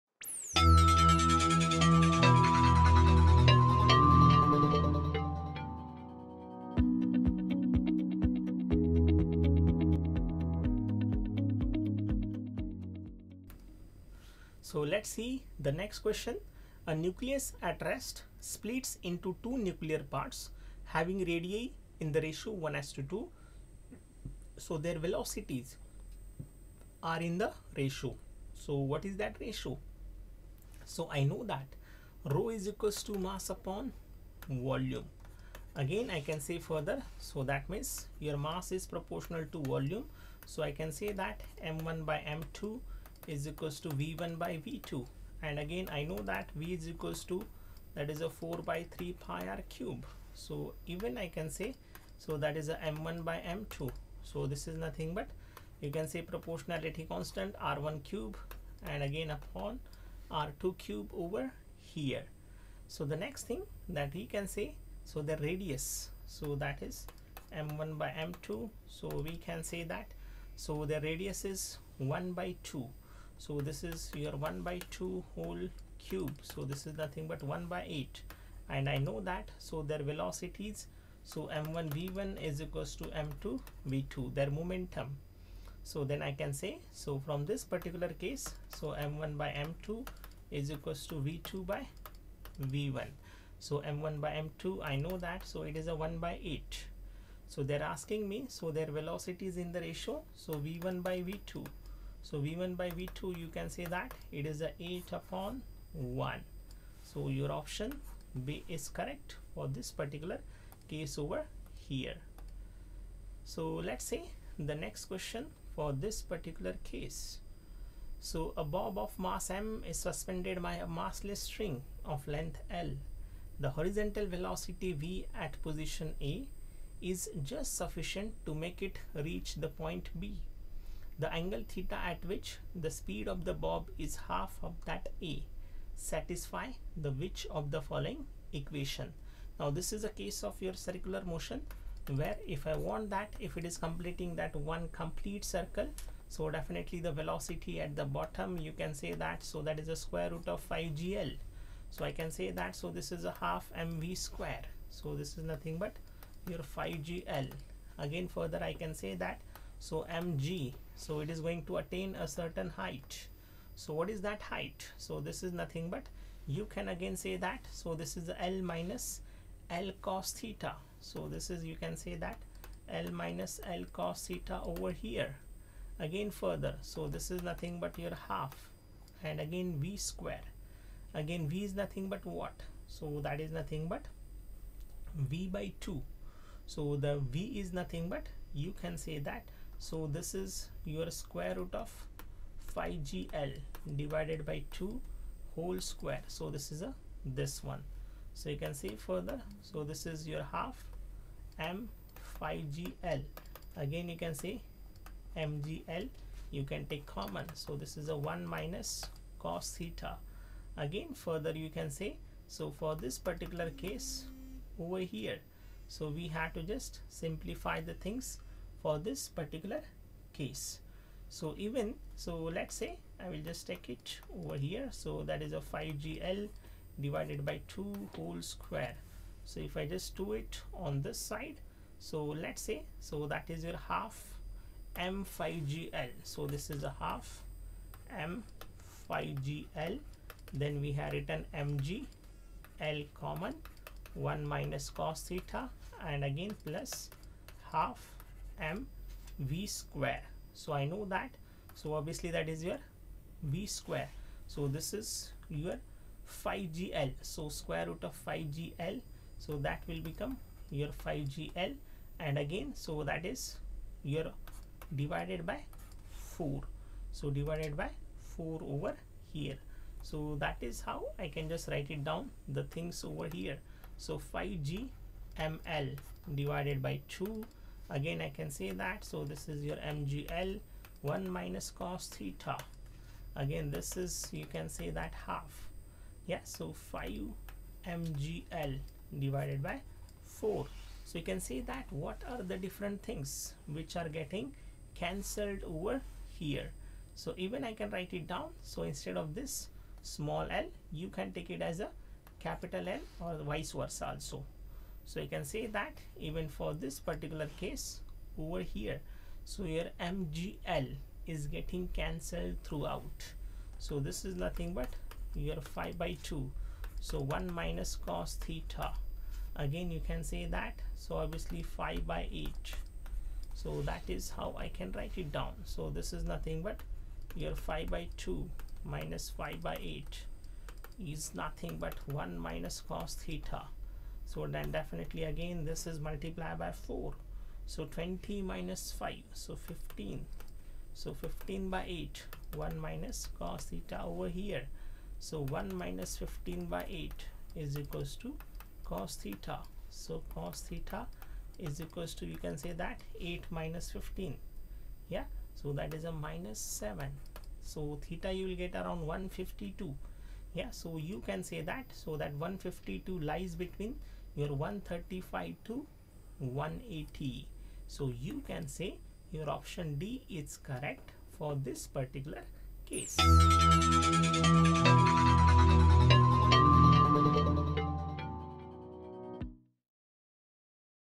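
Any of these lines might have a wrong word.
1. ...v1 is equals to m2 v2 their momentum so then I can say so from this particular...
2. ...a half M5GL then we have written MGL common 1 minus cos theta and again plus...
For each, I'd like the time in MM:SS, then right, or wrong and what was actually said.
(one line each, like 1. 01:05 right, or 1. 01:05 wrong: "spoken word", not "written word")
1. 01:21 right
2. 03:56 right.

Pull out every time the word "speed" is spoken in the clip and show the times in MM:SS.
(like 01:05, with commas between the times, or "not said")
02:12.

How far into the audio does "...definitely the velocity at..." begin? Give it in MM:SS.
02:26.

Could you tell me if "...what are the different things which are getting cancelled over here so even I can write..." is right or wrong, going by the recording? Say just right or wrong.
right.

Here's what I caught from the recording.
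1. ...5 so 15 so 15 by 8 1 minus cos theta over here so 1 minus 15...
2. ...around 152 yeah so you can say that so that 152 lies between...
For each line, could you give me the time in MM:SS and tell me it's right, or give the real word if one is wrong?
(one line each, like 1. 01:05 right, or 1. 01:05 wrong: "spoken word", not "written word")
1. 05:38 right
2. 05:58 right.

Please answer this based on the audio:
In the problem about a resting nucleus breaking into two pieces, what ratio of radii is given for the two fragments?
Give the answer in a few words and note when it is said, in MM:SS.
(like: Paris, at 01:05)
1 to 2, at 00:22.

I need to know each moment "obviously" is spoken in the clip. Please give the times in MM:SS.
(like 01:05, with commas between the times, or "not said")
04:11, 05:21.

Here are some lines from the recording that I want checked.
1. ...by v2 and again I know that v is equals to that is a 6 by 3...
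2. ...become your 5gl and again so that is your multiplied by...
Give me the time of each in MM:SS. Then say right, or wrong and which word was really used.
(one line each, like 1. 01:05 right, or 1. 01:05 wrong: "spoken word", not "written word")
1. 00:44 wrong: "4", not "6"
2. 04:20 wrong: "divided", not "multiplied".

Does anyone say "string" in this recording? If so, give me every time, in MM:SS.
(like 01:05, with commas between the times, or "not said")
02:01.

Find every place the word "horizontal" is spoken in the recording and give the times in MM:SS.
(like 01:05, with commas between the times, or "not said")
02:03.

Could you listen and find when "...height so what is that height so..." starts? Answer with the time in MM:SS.
02:42.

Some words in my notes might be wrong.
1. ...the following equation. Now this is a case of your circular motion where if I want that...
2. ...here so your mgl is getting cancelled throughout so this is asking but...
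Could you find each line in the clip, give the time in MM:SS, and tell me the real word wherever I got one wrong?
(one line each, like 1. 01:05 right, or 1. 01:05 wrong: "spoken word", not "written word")
1. 02:17 right
2. 05:08 wrong: "nothing", not "asking".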